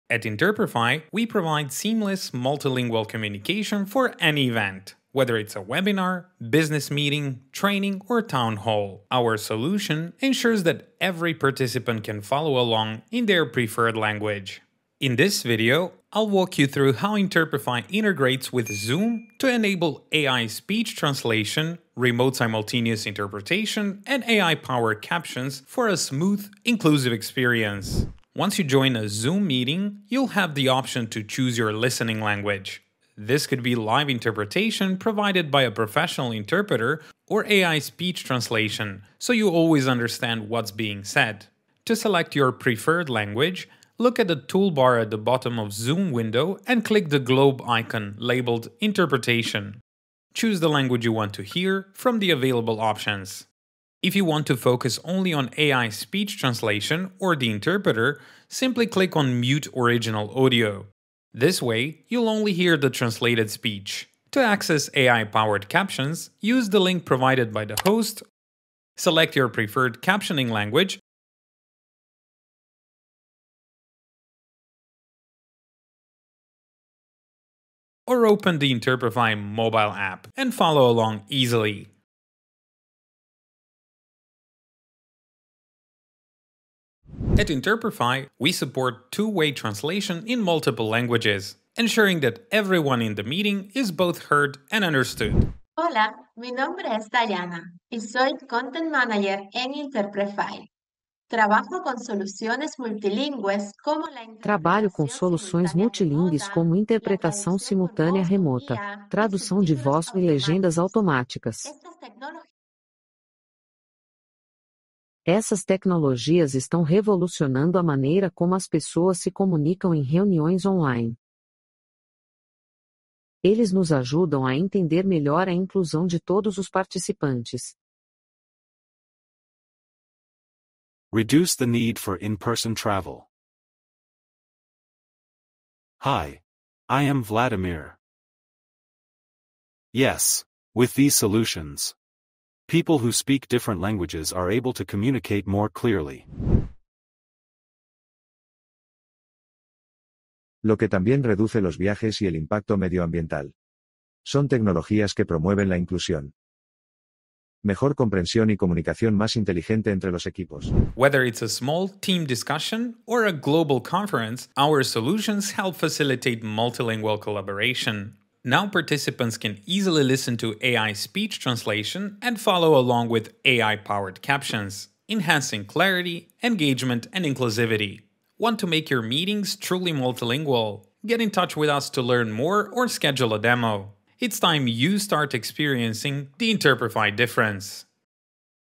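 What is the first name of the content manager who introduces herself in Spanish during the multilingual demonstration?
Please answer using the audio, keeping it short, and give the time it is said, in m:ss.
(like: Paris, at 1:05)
Dayana, at 1:37.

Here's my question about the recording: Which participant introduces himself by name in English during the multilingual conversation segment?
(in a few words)
Vladimir.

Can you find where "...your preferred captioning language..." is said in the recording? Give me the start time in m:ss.
1:09.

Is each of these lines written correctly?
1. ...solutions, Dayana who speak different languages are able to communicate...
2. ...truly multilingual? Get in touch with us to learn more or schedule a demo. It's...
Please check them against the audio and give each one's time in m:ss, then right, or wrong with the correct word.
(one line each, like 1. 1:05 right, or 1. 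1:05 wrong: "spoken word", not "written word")
1. 2:21 wrong: "People", not "Dayana"
2. 2:59 right.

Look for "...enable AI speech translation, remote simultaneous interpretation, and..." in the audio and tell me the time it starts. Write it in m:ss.
0:19.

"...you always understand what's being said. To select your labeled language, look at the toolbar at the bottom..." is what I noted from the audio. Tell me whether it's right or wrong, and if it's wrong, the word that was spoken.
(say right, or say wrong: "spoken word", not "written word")
wrong: "preferred", not "labeled".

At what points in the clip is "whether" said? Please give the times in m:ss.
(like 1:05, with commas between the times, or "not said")
0:05, 2:40.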